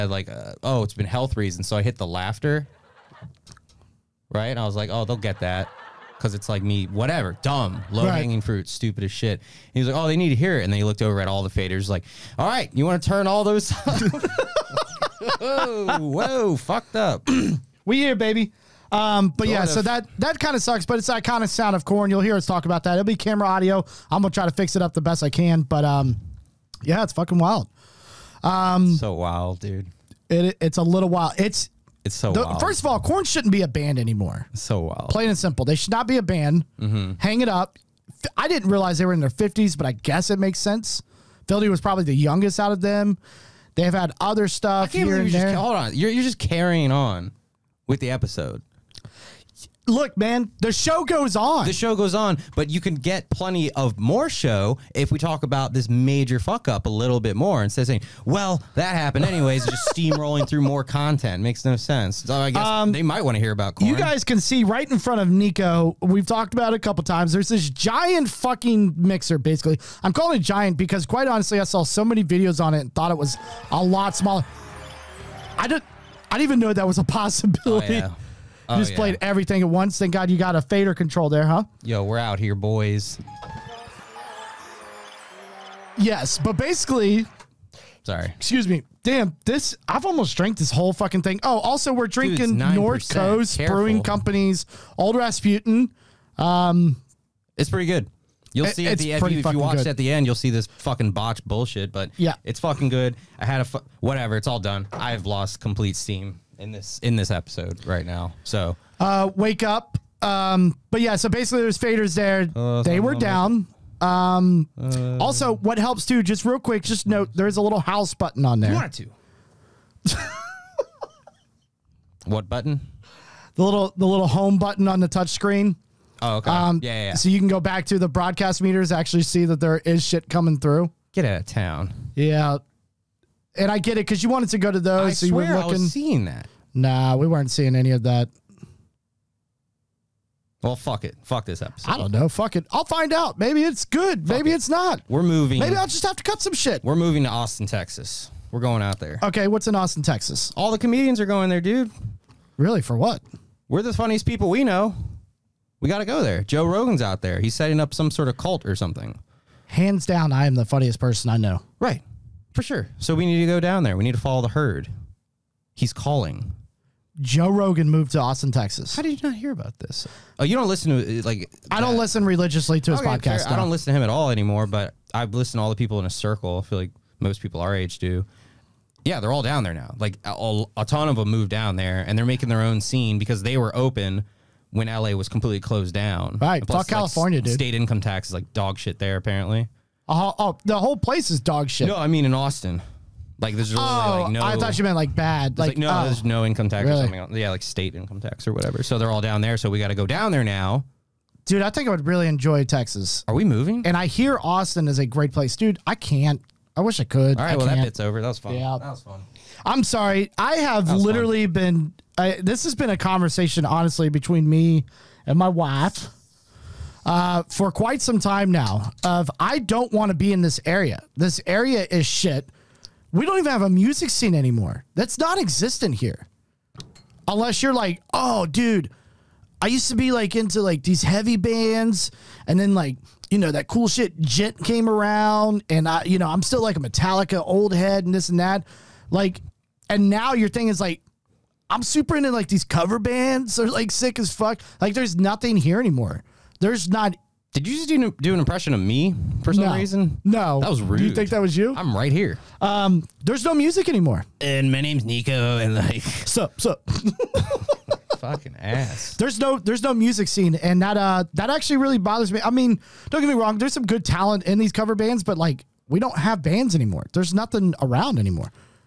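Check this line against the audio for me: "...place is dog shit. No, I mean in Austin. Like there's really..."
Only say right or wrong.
right.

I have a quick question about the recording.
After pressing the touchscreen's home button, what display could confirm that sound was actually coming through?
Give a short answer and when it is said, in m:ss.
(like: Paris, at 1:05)
broadcast meters, at 2:08.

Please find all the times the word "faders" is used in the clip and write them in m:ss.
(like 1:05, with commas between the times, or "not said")
0:11, 1:20, 1:51.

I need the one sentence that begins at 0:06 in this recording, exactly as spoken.
Cause it's like me, whatever, dumb, low hanging fruit, stupid as shit.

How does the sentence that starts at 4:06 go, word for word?
There's not did you just do, do an impression of me for some no.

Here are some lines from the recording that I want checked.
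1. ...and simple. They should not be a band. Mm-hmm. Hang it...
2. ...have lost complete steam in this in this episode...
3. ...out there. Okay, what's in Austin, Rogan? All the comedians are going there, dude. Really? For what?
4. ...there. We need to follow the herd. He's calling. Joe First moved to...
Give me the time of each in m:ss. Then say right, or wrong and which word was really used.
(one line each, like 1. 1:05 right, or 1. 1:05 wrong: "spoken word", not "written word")
1. 0:35 right
2. 1:45 right
3. 2:28 wrong: "Texas", not "Rogan"
4. 2:43 wrong: "Rogan", not "First".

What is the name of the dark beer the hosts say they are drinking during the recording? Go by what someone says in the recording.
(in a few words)
Old Rasputin.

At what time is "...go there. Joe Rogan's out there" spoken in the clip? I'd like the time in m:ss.
2:36.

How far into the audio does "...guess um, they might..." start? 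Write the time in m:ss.
1:02.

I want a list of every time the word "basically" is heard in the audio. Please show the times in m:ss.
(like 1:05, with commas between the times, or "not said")
1:09, 1:26, 1:51.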